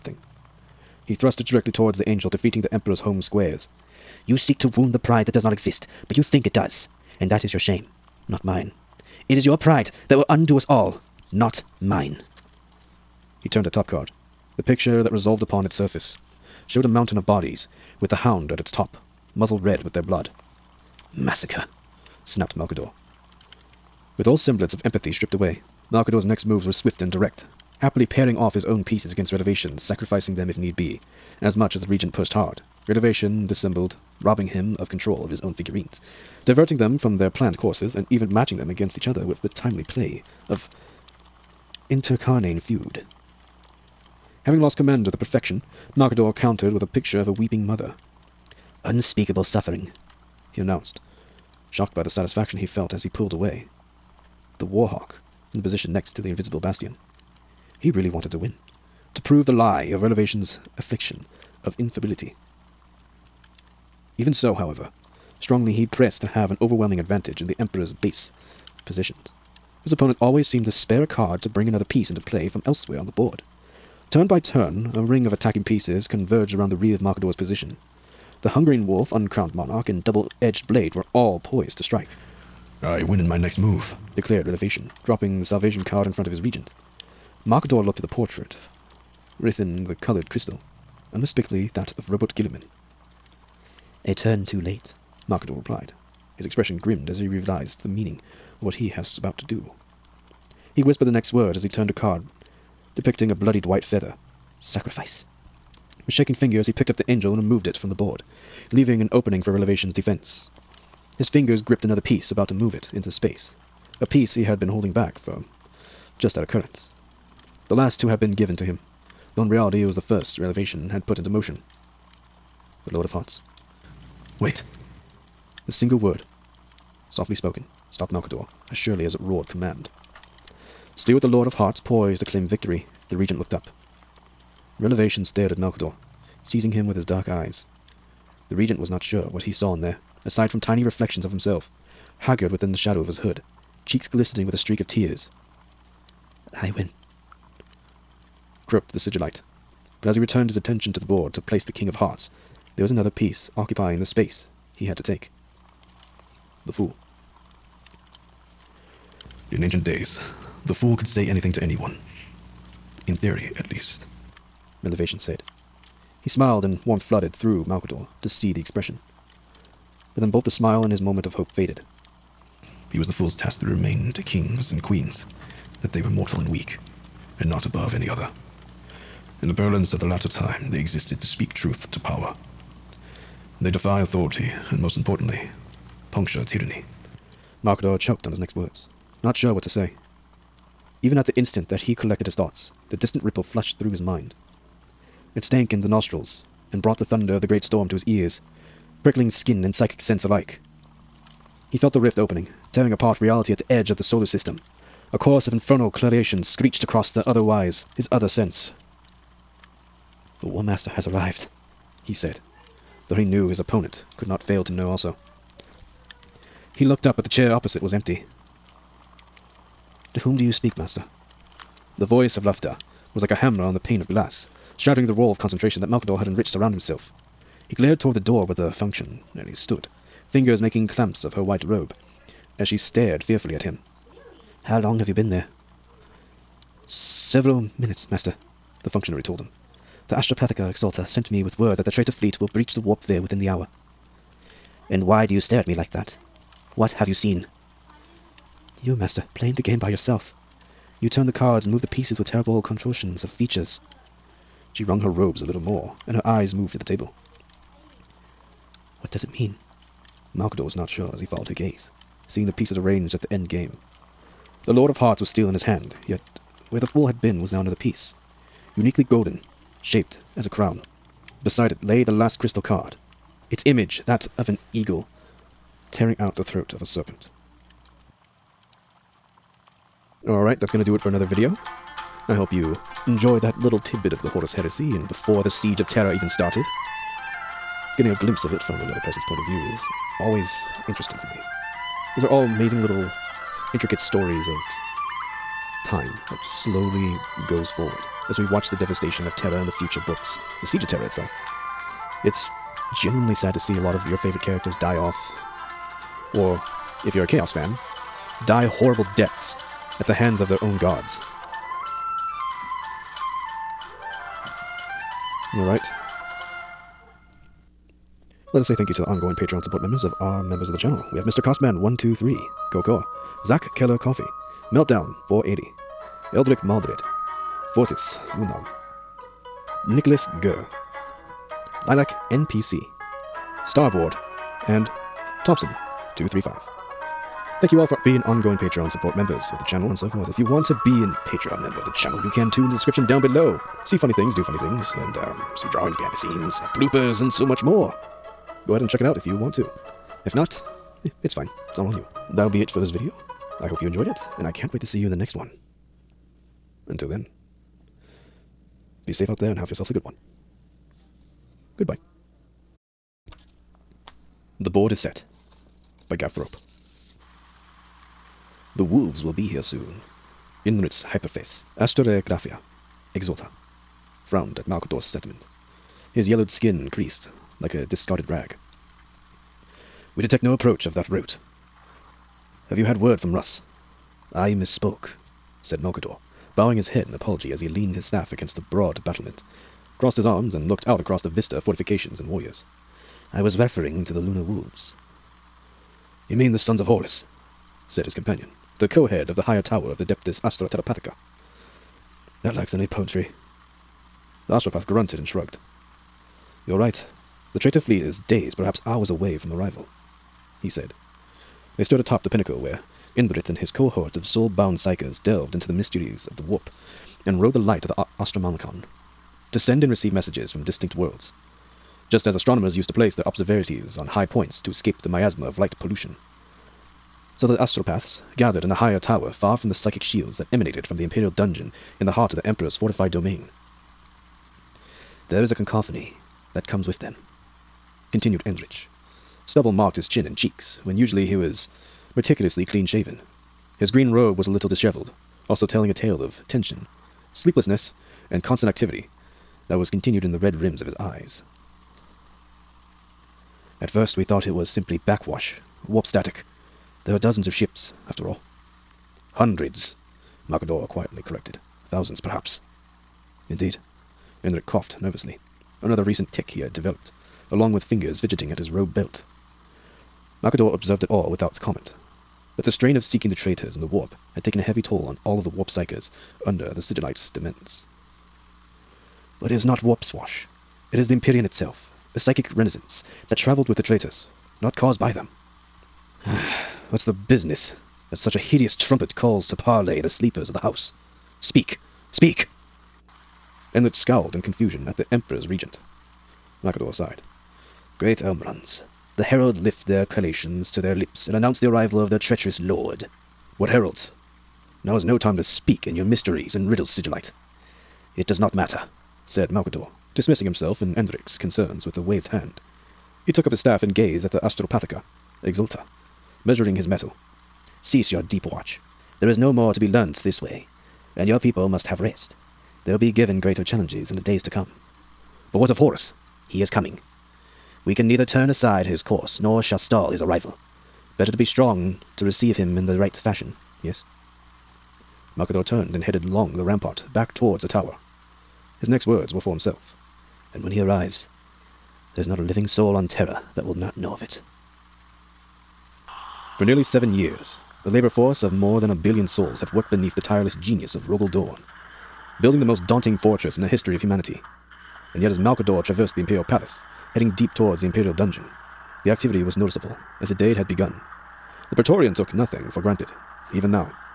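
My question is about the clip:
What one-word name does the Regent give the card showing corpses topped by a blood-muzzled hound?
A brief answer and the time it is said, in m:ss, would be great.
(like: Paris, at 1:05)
Massacre, at 0:21.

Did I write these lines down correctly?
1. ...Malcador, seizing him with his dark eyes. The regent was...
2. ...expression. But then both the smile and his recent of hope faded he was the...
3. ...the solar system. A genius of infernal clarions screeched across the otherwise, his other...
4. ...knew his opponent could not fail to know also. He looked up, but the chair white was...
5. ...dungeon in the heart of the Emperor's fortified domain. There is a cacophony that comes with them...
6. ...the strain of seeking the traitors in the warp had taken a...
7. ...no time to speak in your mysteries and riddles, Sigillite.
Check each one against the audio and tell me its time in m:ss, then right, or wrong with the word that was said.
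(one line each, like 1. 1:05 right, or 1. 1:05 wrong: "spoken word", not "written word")
1. 2:15 right
2. 2:48 wrong: "moment", not "recent"
3. 3:23 wrong: "chorus", not "genius"
4. 3:33 wrong: "opposite", not "white"
5. 7:11 right
6. 7:52 right
7. 8:25 right.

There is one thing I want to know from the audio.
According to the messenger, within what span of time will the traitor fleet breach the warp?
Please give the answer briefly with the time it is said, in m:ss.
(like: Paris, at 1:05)
within the hour, at 4:03.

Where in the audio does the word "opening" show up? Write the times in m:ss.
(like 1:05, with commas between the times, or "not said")
1:49, 3:22.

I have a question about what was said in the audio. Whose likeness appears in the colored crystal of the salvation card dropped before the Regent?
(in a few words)
Roboute Guilliman.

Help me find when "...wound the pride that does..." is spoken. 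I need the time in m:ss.
0:04.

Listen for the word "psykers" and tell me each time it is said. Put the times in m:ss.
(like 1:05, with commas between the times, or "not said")
6:54, 7:55.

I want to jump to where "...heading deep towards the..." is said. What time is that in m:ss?
9:17.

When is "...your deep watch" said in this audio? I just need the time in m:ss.
8:38.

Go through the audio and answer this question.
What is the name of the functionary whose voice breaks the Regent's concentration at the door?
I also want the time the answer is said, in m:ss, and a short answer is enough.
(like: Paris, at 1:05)
Lufta, at 3:42.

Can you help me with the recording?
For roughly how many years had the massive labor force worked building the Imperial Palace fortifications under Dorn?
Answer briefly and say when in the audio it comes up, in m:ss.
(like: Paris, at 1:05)
7, at 9:06.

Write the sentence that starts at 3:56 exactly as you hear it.
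Several minutes, master, the functionary told him.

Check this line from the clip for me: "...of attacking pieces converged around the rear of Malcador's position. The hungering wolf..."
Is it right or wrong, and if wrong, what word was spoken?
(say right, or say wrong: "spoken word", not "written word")
right.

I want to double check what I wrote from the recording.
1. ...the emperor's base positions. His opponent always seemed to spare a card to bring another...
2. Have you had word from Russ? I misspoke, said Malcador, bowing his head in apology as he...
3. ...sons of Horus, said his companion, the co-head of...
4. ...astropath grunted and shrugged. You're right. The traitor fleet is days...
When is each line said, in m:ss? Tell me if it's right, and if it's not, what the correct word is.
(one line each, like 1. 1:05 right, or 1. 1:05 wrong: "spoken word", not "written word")
1. 1:07 right
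2. 6:22 right
3. 6:36 right
4. 6:44 right.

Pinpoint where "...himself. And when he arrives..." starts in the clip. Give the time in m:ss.
8:59.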